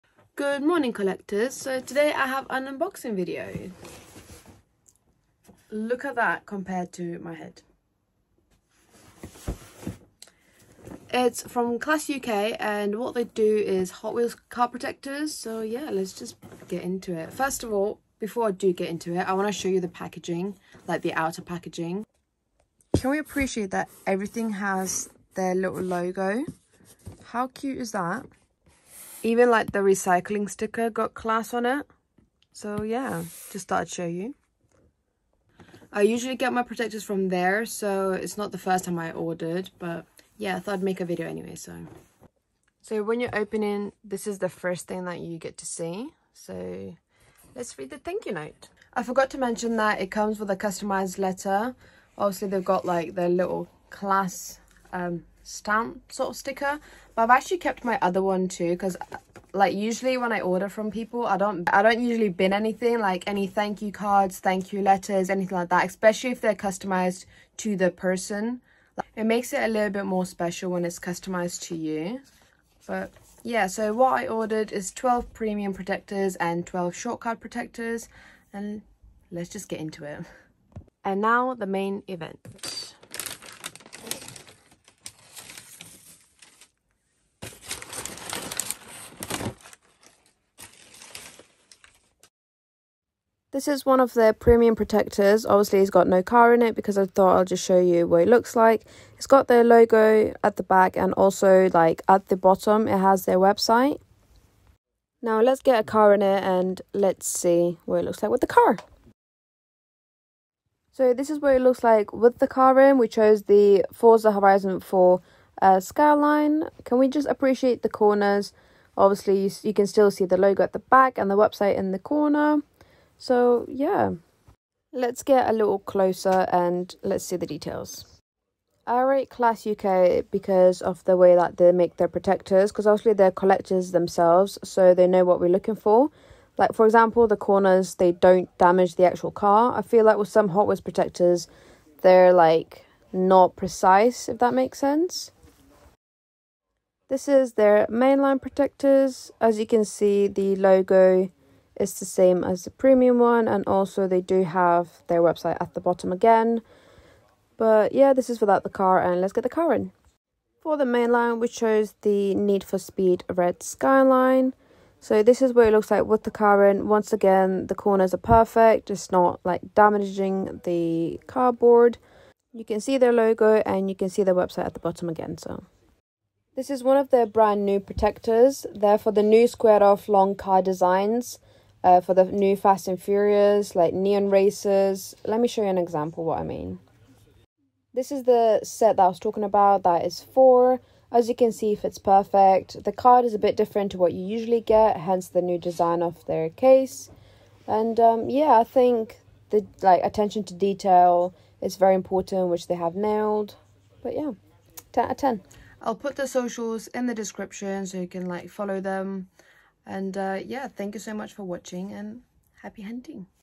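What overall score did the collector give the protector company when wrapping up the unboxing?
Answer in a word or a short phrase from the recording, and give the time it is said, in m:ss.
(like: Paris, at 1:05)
10 out of 10, at 3:24.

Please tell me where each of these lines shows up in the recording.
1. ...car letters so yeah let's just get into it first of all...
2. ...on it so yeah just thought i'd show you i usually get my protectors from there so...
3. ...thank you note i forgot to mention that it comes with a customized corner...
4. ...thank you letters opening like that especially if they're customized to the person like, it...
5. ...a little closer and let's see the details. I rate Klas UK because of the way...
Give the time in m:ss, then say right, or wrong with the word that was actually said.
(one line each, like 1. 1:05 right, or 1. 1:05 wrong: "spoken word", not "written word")
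1. 0:14 wrong: "protectors", not "letters"
2. 0:31 right
3. 0:47 wrong: "letter", not "corner"
4. 1:04 wrong: "anything", not "opening"
5. 2:05 right.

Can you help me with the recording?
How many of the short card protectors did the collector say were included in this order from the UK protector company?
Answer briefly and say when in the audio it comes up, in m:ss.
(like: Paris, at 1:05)
12, at 1:16.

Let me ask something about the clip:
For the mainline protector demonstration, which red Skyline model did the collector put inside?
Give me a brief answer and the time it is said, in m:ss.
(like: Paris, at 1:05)
Need for Speed Red Skyline, at 2:42.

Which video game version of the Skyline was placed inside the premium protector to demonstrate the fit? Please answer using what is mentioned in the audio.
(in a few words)
Forza Horizon 4.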